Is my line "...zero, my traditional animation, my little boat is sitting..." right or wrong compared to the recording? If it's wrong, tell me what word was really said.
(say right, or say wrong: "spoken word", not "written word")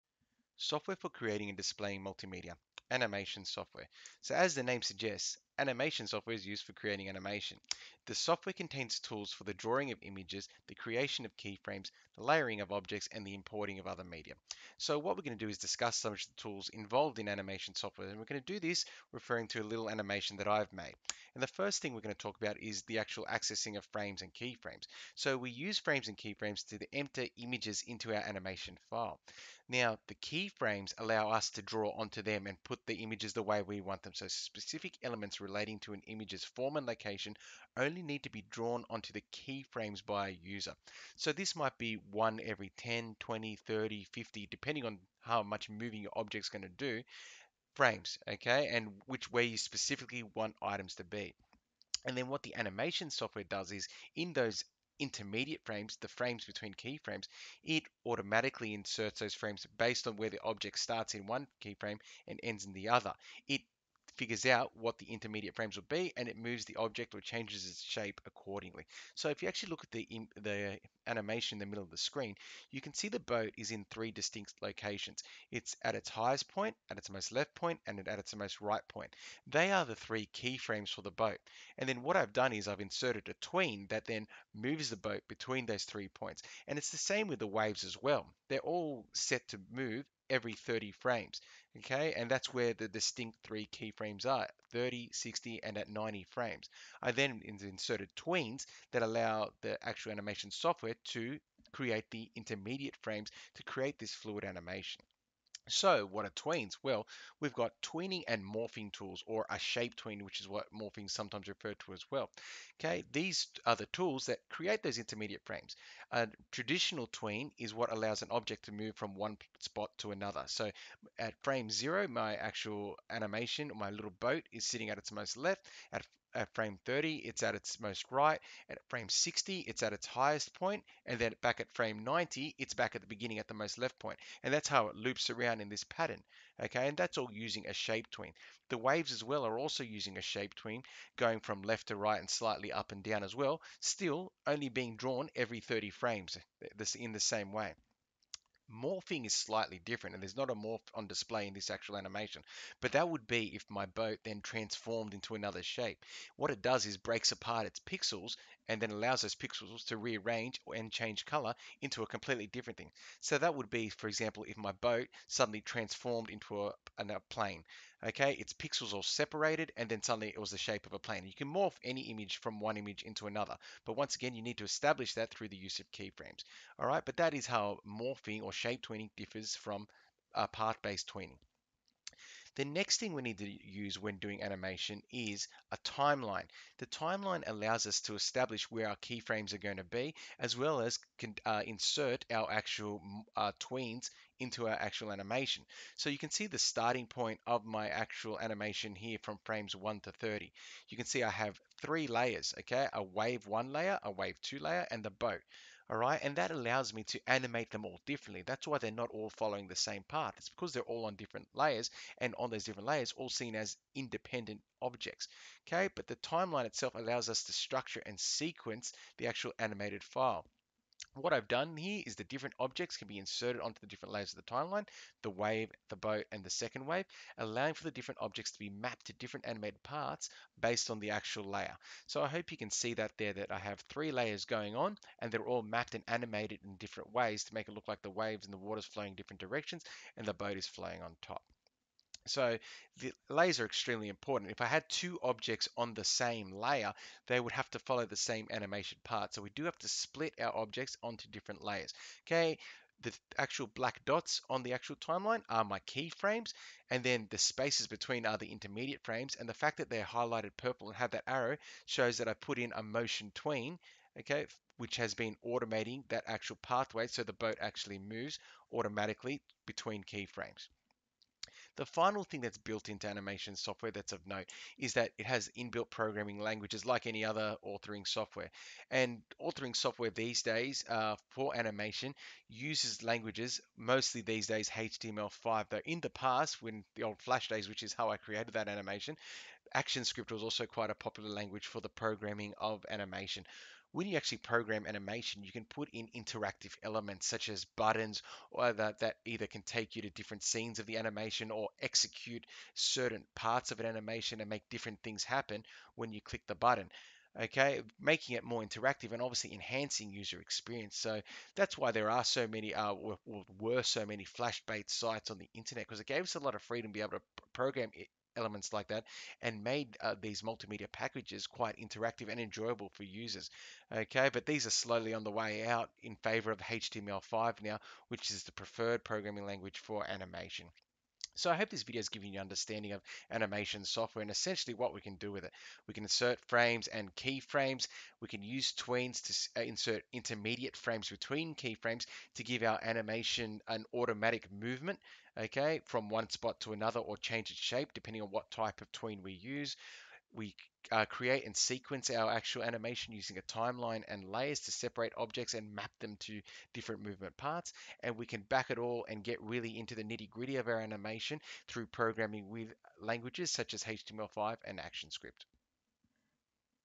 wrong: "actual", not "traditional".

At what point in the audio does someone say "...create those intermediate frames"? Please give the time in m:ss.
1:54.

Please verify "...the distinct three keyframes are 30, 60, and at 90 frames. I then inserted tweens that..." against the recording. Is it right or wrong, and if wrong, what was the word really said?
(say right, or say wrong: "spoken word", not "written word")
right.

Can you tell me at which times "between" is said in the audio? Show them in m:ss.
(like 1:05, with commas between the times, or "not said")
0:56, 1:25, 4:17, 4:29, 5:41.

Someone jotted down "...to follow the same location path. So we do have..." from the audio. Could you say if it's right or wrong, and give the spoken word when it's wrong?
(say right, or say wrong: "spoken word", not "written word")
wrong: "animation", not "location".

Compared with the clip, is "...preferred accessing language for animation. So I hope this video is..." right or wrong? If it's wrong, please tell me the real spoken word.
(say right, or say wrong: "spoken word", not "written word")
wrong: "programming", not "accessing".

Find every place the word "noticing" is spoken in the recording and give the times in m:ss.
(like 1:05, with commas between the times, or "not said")
not said.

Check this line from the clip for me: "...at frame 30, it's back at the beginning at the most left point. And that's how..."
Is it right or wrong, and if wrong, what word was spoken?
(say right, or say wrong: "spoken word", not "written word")
wrong: "90", not "30".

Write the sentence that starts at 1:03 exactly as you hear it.
It figures out what the intermediate frames will be and it moves the object or changes its shape accordingly.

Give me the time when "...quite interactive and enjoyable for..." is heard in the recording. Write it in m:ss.
5:21.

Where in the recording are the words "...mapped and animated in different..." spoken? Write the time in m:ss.
3:55.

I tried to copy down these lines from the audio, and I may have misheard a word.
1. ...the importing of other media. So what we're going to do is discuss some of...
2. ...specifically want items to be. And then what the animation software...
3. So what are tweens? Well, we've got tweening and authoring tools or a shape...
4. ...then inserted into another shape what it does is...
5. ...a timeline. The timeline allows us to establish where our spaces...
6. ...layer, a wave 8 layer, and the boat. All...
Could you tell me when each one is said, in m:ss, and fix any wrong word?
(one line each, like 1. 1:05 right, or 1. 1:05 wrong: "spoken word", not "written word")
1. 0:13 right
2. 0:49 right
3. 1:45 wrong: "morphing", not "authoring"
4. 2:34 wrong: "transformed", not "inserted"
5. 3:05 wrong: "keyframes", not "spaces"
6. 3:23 wrong: "2", not "8".